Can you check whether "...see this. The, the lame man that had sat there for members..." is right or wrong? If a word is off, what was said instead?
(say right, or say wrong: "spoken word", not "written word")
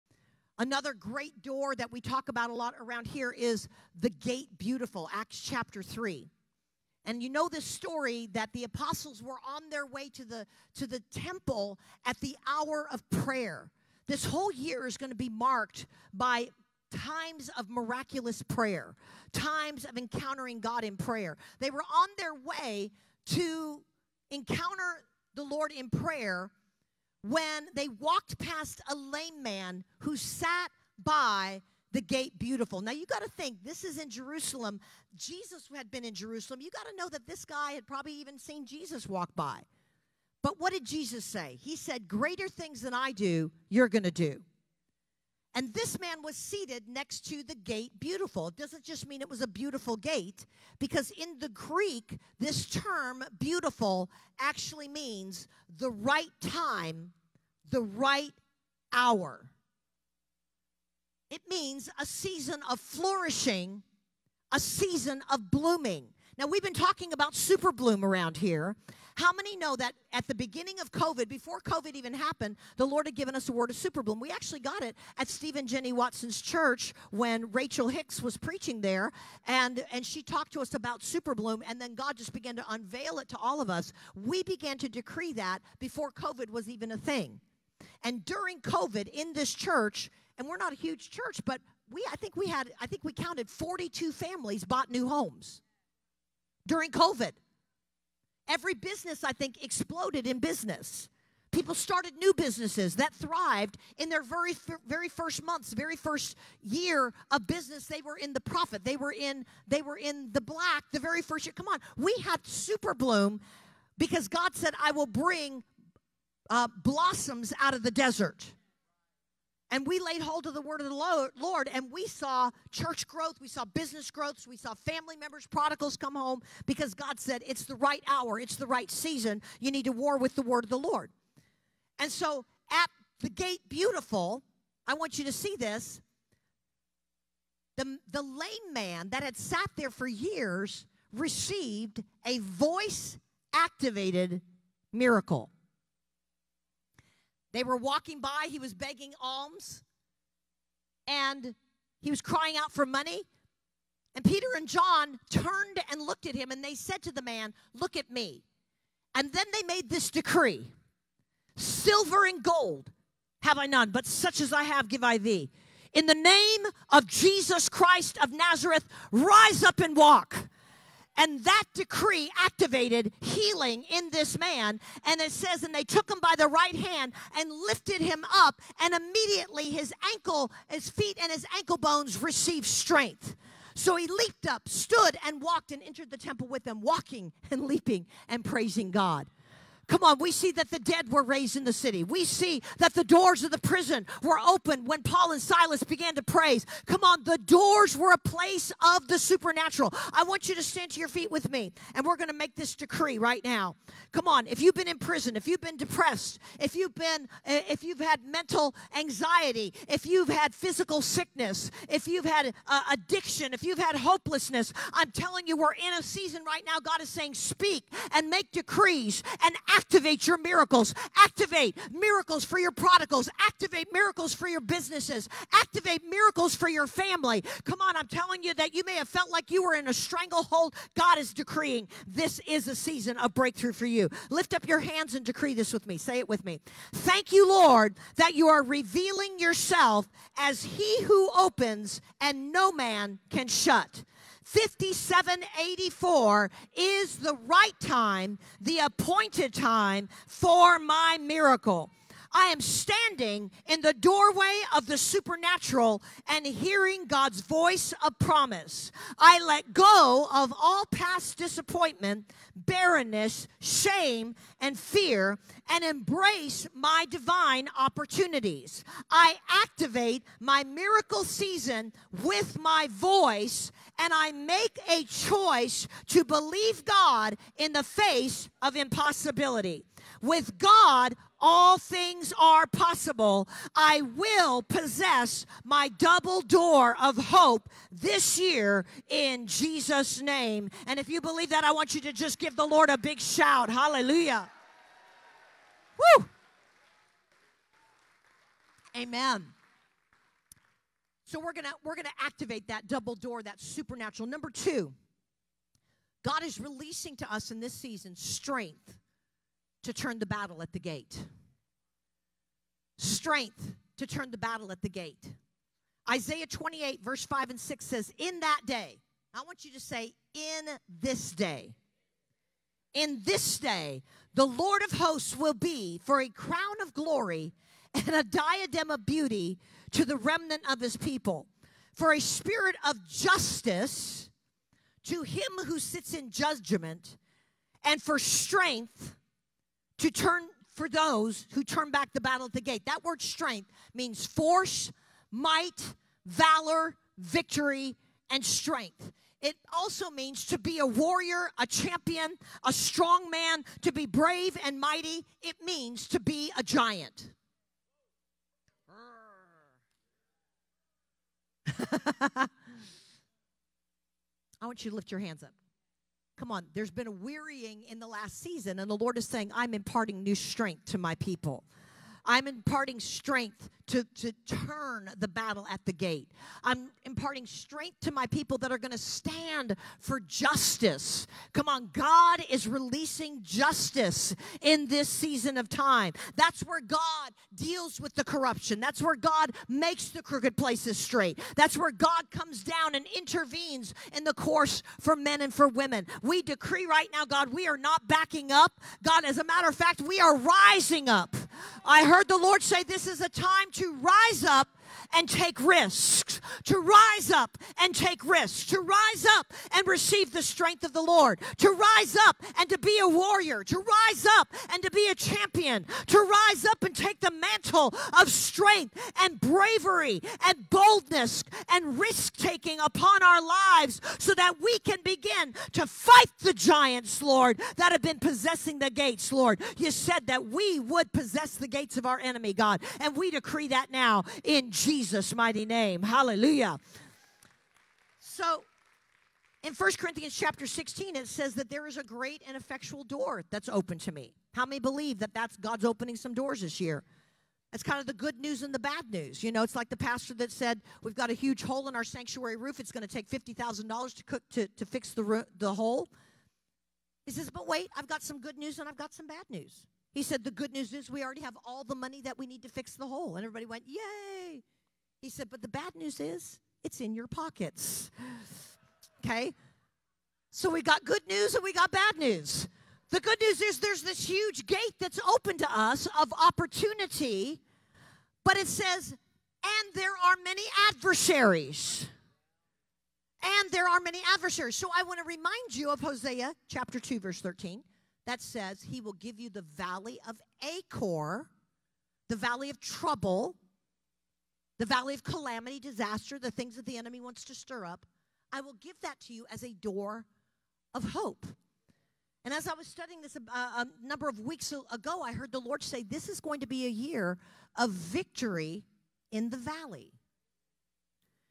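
wrong: "years", not "members".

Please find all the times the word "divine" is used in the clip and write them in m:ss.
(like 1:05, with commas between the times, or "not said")
4:27.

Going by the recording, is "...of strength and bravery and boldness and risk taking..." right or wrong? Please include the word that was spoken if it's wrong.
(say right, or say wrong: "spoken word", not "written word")
right.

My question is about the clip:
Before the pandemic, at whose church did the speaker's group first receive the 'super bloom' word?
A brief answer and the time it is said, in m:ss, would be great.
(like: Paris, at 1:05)
Stephen Jenny Watson's, at 1:15.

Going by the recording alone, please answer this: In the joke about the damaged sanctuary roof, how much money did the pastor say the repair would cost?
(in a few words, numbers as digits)
$50,000.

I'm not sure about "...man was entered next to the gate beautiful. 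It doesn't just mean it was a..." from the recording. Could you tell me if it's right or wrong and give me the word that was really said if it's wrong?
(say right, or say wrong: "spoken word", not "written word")
wrong: "seated", not "entered".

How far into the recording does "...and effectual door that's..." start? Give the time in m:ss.
7:22.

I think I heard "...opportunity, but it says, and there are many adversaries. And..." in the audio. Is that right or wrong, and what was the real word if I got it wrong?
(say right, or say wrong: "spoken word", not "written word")
right.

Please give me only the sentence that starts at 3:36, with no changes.
God is saying, speak and make decrees and act Activate your miracles.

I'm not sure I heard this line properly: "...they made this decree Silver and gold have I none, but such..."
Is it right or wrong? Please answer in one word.
right.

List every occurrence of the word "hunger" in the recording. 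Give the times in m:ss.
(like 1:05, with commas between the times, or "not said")
not said.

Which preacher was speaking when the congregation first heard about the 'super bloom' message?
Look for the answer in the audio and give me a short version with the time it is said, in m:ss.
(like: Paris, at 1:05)
Rachel Hickson, at 1:17.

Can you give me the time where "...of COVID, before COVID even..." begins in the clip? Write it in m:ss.
1:10.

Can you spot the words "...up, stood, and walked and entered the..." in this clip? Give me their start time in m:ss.
3:04.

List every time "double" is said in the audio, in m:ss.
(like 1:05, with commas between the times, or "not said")
4:45, 5:02.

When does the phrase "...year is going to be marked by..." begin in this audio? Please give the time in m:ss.
0:14.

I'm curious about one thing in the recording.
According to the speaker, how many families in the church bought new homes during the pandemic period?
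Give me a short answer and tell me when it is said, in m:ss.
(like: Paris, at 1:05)
42, at 1:33.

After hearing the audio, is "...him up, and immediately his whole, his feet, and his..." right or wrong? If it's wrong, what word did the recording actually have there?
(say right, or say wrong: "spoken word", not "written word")
wrong: "ankle", not "whole".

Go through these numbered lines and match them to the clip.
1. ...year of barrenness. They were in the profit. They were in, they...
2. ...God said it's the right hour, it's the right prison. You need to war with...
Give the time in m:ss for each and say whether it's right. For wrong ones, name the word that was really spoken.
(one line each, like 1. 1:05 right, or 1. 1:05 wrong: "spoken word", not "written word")
1. 1:46 wrong: "business", not "barrenness"
2. 2:06 wrong: "season", not "prison".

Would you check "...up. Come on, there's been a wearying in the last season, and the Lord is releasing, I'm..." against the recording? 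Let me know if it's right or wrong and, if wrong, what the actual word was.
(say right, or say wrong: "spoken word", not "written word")
wrong: "saying", not "releasing".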